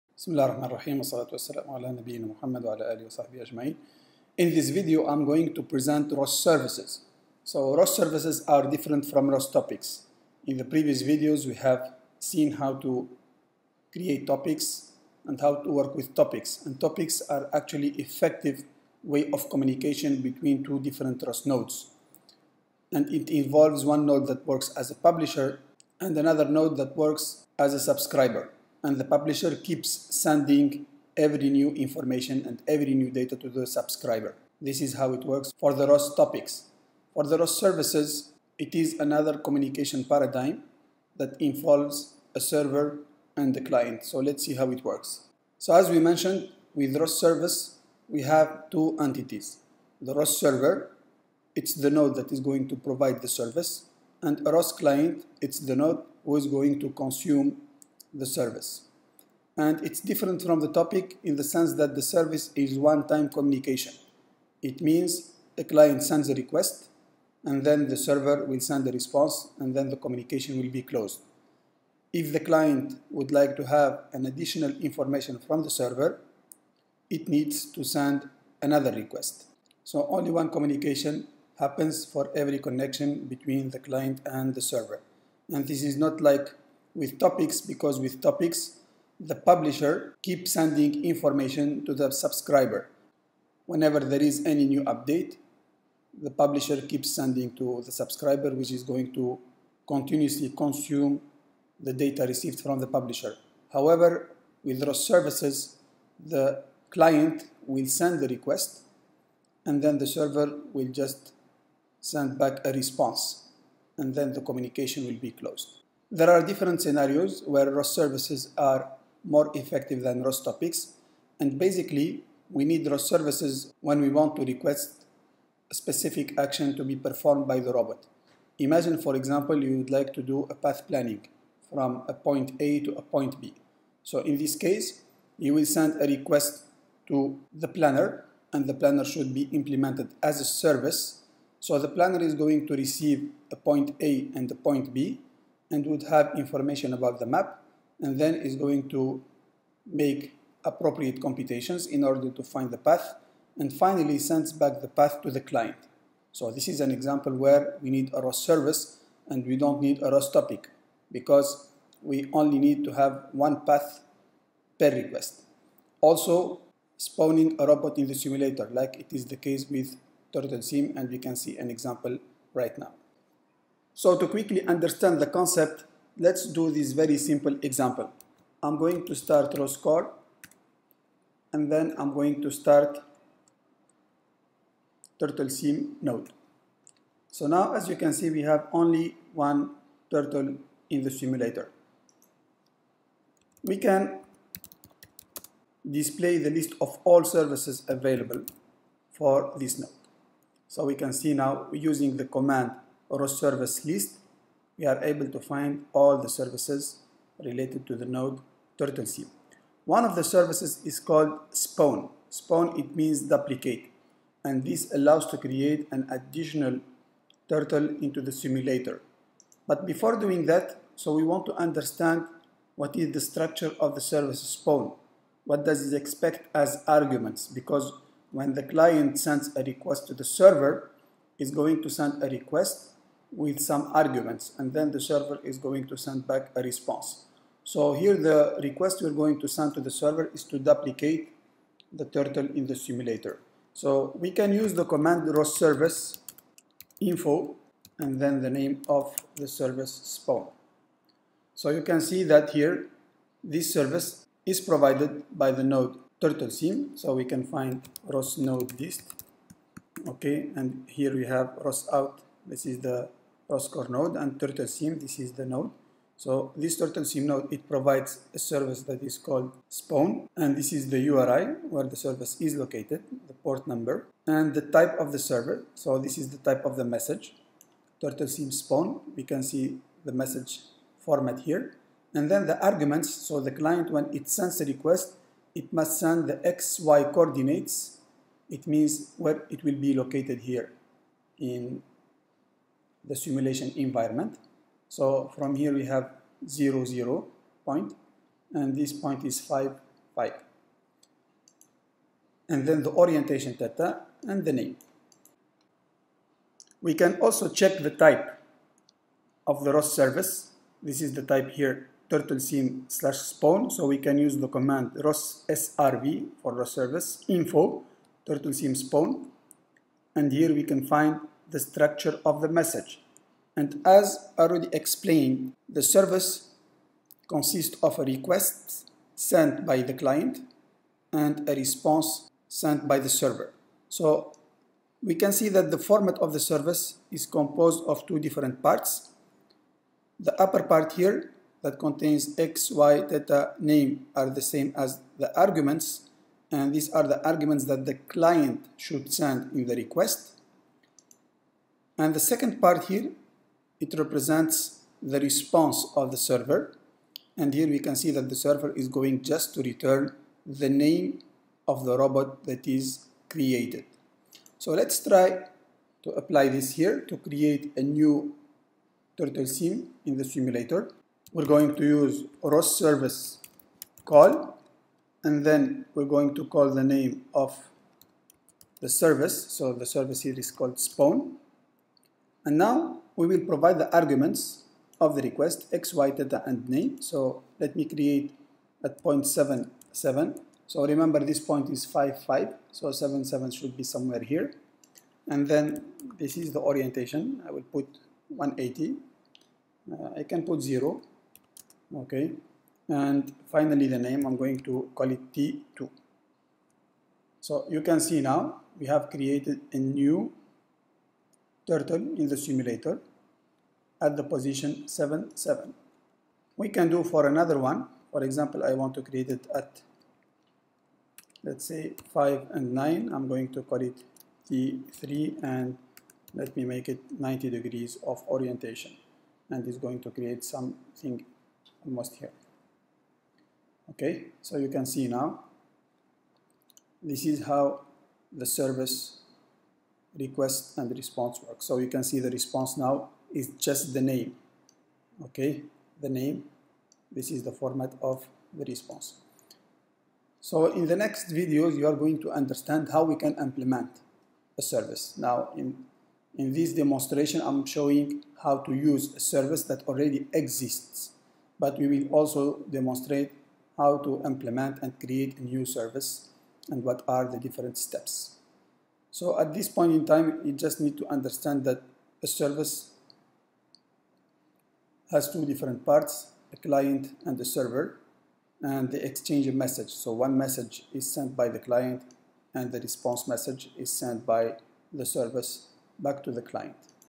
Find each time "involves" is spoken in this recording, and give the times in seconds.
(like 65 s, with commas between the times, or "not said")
23 s, 41 s.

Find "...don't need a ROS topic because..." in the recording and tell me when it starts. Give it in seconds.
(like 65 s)
159 s.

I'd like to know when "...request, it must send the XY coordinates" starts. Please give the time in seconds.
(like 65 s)
284 s.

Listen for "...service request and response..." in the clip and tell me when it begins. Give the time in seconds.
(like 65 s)
438 s.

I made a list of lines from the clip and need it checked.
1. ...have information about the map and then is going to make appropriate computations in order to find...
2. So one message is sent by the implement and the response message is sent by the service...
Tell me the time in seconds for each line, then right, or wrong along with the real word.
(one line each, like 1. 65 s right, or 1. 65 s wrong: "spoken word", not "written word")
1. 146 s right
2. 479 s wrong: "client", not "implement".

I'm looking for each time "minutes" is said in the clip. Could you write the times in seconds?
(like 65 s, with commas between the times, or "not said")
not said.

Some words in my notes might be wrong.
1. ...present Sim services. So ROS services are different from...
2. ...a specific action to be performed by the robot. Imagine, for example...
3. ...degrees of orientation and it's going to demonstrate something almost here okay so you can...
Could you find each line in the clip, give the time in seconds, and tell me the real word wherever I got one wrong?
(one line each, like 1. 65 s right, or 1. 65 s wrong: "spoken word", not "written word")
1. 5 s wrong: "ROS", not "Sim"
2. 125 s right
3. 427 s wrong: "create", not "demonstrate".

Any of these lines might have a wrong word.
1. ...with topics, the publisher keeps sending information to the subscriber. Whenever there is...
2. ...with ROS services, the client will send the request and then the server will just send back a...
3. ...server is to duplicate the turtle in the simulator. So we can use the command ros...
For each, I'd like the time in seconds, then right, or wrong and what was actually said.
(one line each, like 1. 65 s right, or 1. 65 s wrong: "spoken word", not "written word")
1. 87 s right
2. 104 s right
3. 239 s right.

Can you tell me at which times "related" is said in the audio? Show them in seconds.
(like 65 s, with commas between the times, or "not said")
207 s.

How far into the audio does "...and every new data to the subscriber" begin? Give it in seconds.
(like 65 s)
32 s.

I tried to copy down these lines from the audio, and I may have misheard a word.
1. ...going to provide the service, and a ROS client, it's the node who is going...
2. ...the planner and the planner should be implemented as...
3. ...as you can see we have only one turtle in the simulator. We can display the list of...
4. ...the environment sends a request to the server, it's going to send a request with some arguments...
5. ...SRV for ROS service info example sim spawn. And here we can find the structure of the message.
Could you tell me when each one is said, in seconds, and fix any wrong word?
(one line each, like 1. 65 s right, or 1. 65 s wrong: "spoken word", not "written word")
1. 52 s right
2. 137 s right
3. 187 s right
4. 228 s wrong: "client", not "environment"
5. 315 s wrong: "turtle", not "example".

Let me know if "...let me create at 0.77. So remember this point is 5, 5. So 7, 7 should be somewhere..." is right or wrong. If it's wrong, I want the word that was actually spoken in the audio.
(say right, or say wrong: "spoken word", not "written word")
right.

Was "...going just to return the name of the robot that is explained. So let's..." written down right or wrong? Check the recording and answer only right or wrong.
wrong.